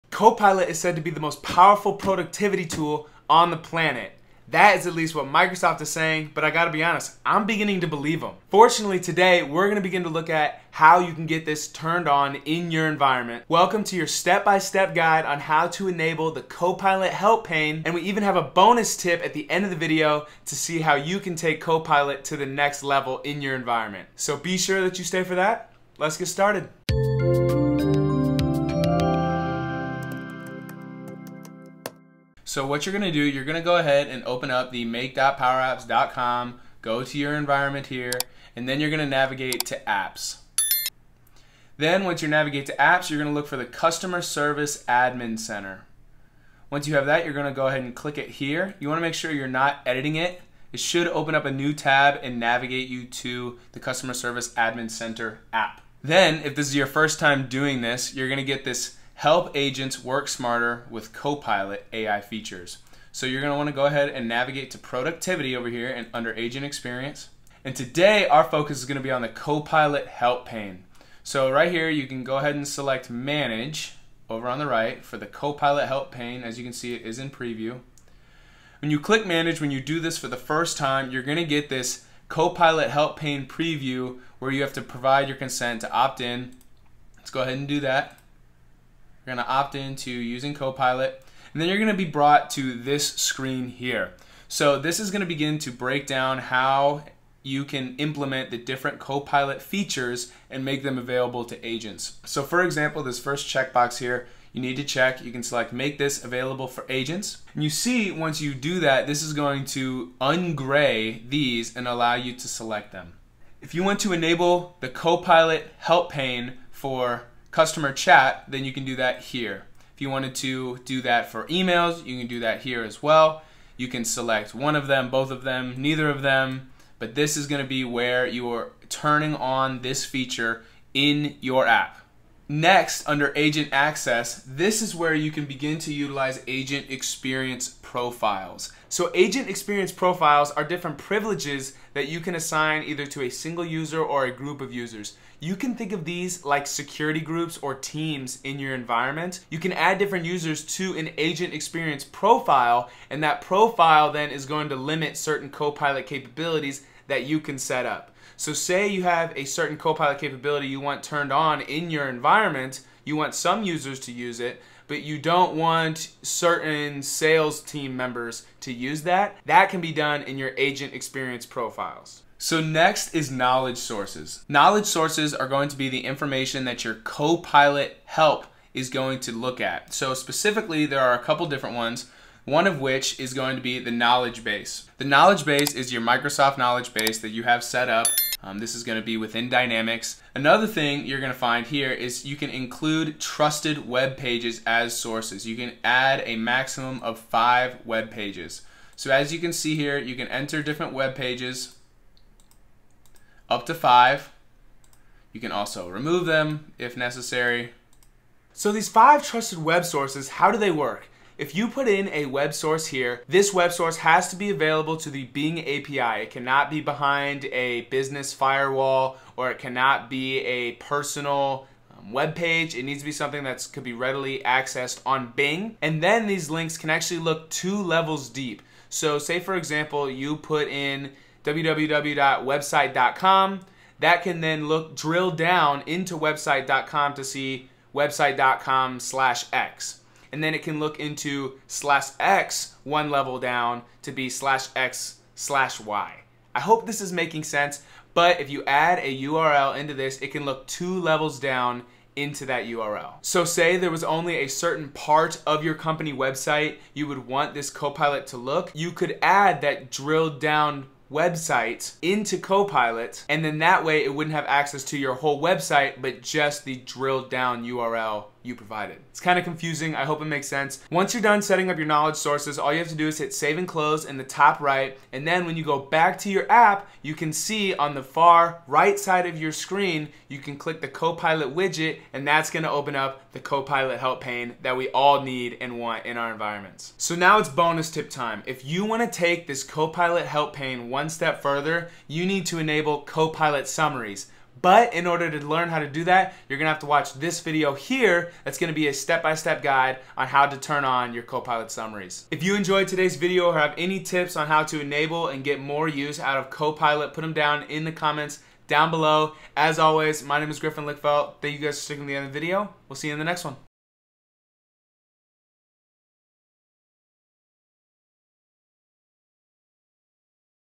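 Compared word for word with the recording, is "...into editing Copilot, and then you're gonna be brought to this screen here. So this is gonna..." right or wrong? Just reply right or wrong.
wrong.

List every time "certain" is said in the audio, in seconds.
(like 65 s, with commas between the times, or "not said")
155 s, 159 s, 166 s, 254 s.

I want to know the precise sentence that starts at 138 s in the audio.
So Agent Experience Profiles are different privileges that you can assign either to a single user or a group of users.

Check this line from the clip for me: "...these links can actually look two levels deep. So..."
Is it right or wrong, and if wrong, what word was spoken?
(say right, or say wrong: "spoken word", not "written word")
right.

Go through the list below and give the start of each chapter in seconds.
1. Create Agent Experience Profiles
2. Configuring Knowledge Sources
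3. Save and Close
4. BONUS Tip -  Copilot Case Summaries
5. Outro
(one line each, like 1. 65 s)
1. 132 s
2. 172 s
3. 274 s
4. 286 s
5. 302 s.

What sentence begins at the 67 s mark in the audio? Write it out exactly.
And today our focus is gonna be on the Copilot help pane.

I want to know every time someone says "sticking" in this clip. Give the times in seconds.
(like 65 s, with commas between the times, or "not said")
311 s.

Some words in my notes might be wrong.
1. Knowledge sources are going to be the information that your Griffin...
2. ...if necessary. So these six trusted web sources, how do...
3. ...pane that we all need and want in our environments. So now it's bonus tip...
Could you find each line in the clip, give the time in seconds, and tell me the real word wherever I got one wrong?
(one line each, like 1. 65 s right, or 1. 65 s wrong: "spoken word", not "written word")
1. 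174 s wrong: "Copilot", not "Griffin"
2. 206 s wrong: "five", not "six"
3. 284 s right.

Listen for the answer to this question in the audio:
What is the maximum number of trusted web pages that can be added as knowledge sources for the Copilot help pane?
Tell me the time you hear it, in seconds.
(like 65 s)
196 s.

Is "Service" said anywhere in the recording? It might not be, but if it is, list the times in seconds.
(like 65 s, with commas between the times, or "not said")
44 s, 54 s.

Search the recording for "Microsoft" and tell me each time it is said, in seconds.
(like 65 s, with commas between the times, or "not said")
5 s, 186 s.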